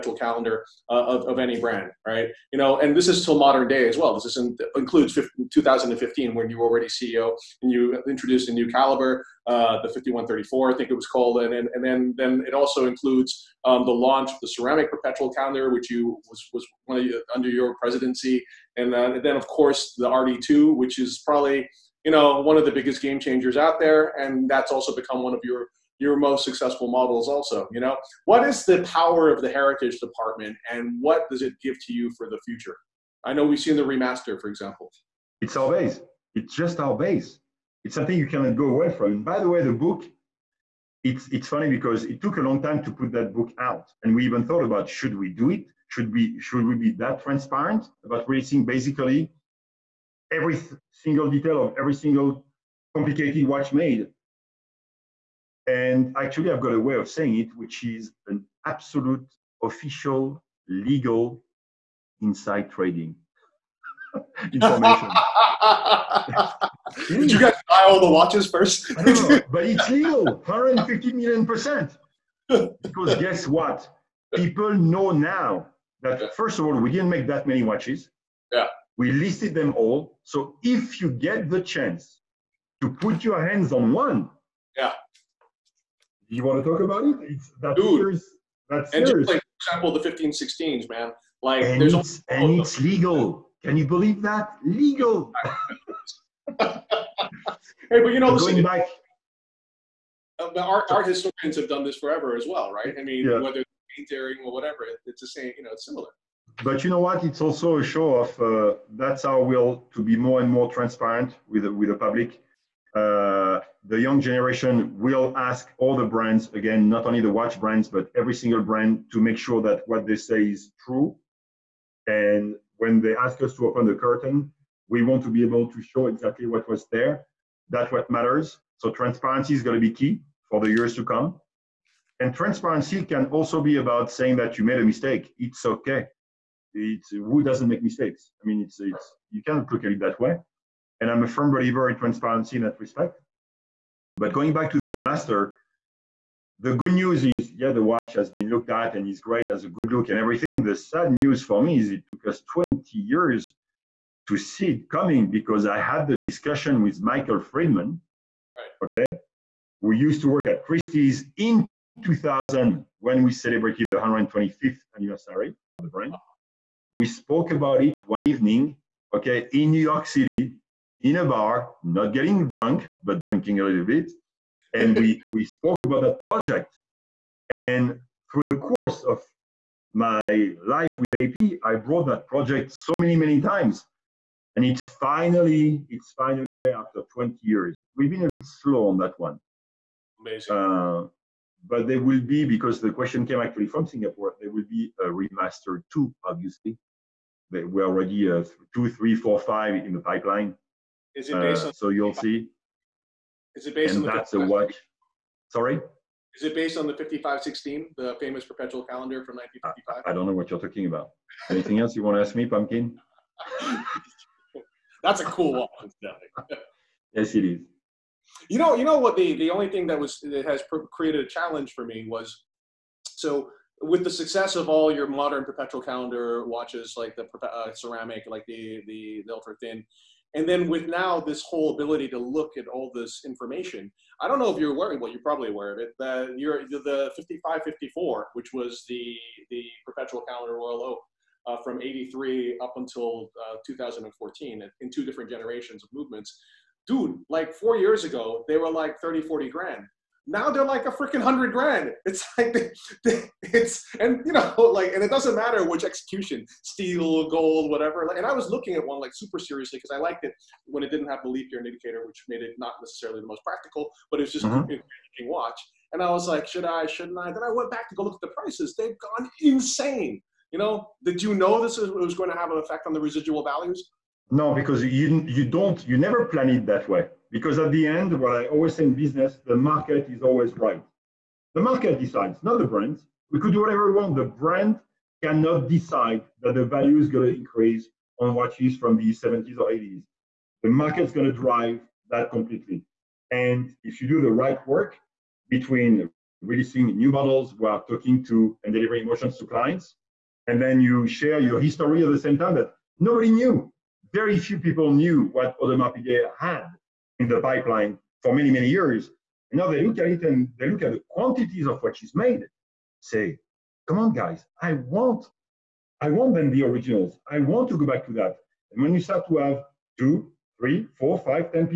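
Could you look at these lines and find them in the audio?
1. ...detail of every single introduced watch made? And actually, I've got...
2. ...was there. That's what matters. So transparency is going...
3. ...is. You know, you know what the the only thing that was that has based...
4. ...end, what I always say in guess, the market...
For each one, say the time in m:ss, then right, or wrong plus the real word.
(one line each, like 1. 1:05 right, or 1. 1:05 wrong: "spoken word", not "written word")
1. 0:51 wrong: "complicated", not "introduced"
2. 2:06 right
3. 3:37 wrong: "created", not "based"
4. 4:37 wrong: "business", not "guess".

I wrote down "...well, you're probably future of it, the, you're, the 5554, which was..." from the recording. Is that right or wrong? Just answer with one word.
wrong.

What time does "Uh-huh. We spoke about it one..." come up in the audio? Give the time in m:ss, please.
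2:46.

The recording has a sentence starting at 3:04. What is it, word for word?
And it's finally, it's finally there after 20 years.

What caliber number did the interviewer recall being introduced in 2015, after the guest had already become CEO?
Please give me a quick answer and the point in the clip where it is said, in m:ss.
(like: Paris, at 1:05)
5134, at 0:09.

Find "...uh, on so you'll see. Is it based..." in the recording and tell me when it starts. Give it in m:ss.
3:21.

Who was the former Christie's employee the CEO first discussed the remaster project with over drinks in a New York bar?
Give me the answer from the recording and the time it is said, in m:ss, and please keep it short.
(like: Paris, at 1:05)
Michael Friedman, at 2:37.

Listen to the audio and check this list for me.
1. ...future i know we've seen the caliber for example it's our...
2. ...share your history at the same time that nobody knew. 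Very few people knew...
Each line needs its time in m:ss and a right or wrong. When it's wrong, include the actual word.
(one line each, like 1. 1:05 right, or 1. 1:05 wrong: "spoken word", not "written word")
1. 0:32 wrong: "remaster", not "caliber"
2. 5:01 right.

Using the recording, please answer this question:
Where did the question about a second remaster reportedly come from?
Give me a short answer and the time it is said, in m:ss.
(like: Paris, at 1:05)
Singapore, at 3:13.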